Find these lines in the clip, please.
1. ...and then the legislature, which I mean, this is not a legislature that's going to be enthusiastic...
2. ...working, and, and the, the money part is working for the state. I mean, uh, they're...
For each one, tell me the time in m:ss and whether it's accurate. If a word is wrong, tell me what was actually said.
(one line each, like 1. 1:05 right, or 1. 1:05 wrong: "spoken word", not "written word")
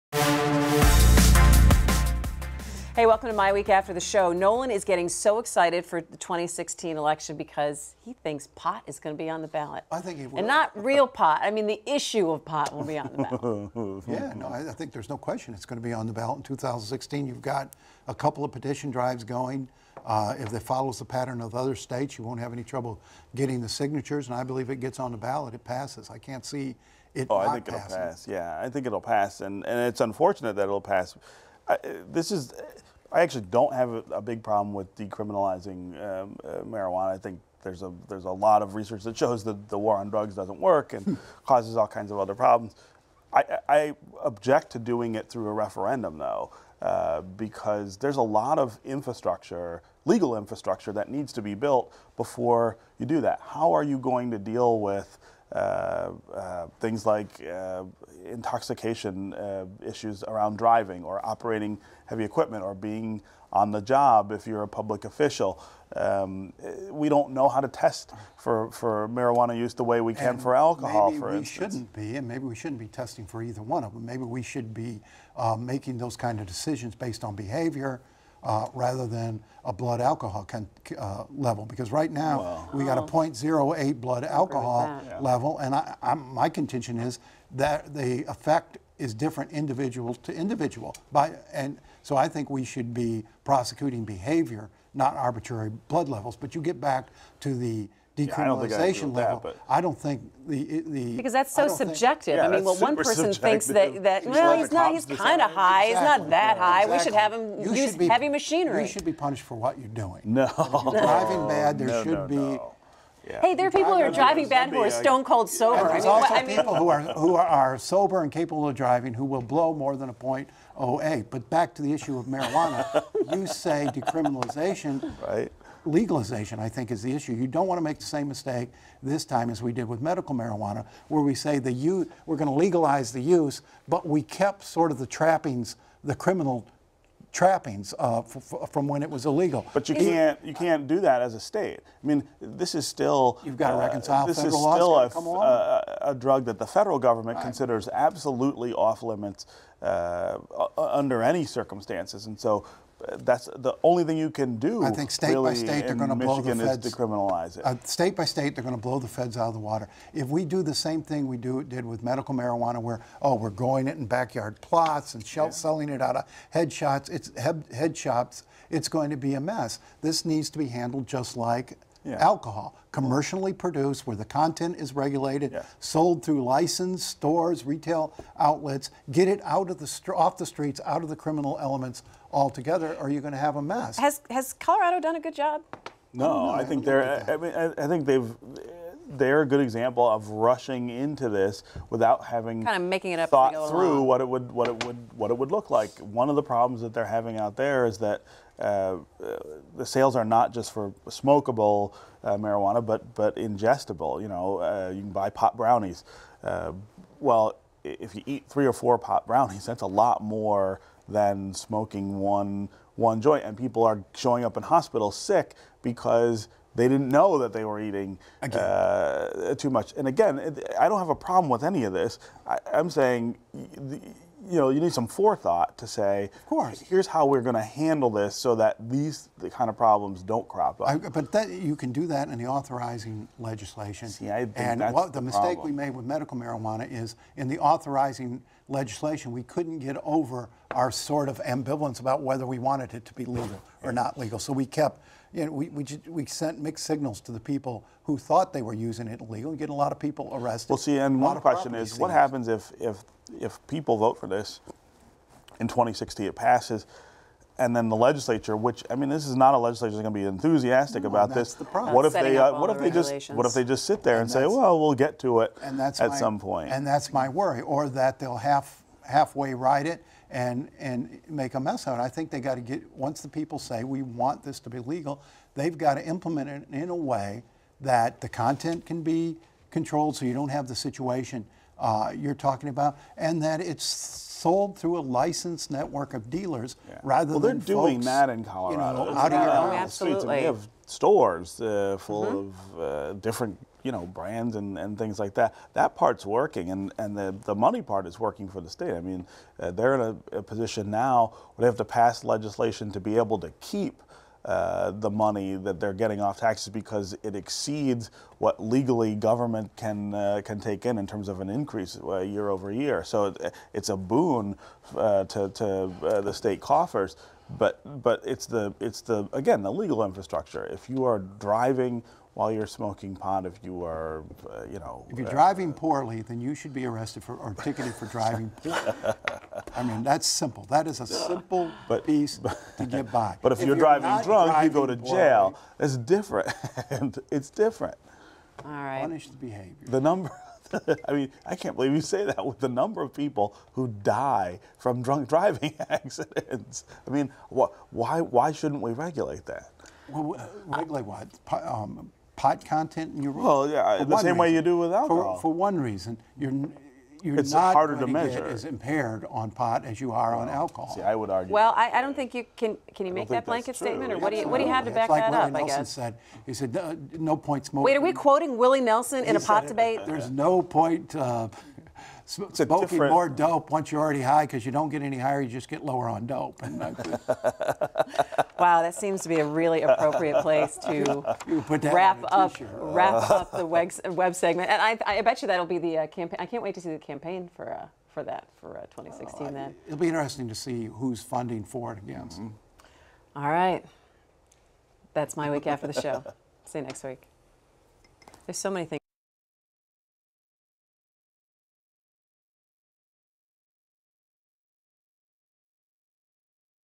1. 4:17 right
2. 4:56 right.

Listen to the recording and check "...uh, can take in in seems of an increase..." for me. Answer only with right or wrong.
wrong.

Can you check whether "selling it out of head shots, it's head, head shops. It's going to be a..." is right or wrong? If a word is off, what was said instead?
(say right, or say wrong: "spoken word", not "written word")
right.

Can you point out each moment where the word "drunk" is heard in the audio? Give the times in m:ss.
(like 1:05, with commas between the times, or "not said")
5:34, 5:45.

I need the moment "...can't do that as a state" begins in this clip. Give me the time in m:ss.
2:20.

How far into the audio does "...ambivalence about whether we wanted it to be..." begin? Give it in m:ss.
4:01.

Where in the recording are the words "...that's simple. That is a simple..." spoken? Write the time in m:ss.
5:30.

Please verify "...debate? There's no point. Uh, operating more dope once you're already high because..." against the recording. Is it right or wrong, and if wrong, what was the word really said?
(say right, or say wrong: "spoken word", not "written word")
wrong: "smoking", not "operating".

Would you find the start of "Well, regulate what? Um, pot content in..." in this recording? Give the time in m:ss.
5:50.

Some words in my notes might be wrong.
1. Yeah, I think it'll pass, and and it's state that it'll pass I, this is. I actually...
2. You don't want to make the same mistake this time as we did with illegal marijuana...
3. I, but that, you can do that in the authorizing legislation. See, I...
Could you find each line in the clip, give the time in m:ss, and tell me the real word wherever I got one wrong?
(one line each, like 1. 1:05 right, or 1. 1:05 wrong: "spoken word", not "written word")
1. 0:28 wrong: "unfortunate", not "state"
2. 2:07 wrong: "medical", not "illegal"
3. 3:50 right.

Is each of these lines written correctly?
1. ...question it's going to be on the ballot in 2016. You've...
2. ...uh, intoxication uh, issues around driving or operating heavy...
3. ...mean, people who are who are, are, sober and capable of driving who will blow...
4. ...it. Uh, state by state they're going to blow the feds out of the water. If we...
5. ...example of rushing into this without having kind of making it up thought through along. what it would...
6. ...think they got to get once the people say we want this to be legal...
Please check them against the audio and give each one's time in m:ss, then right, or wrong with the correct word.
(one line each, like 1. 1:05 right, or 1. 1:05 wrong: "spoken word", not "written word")
1. 0:15 right
2. 0:57 right
3. 1:56 right
4. 2:37 right
5. 3:09 right
6. 4:32 right.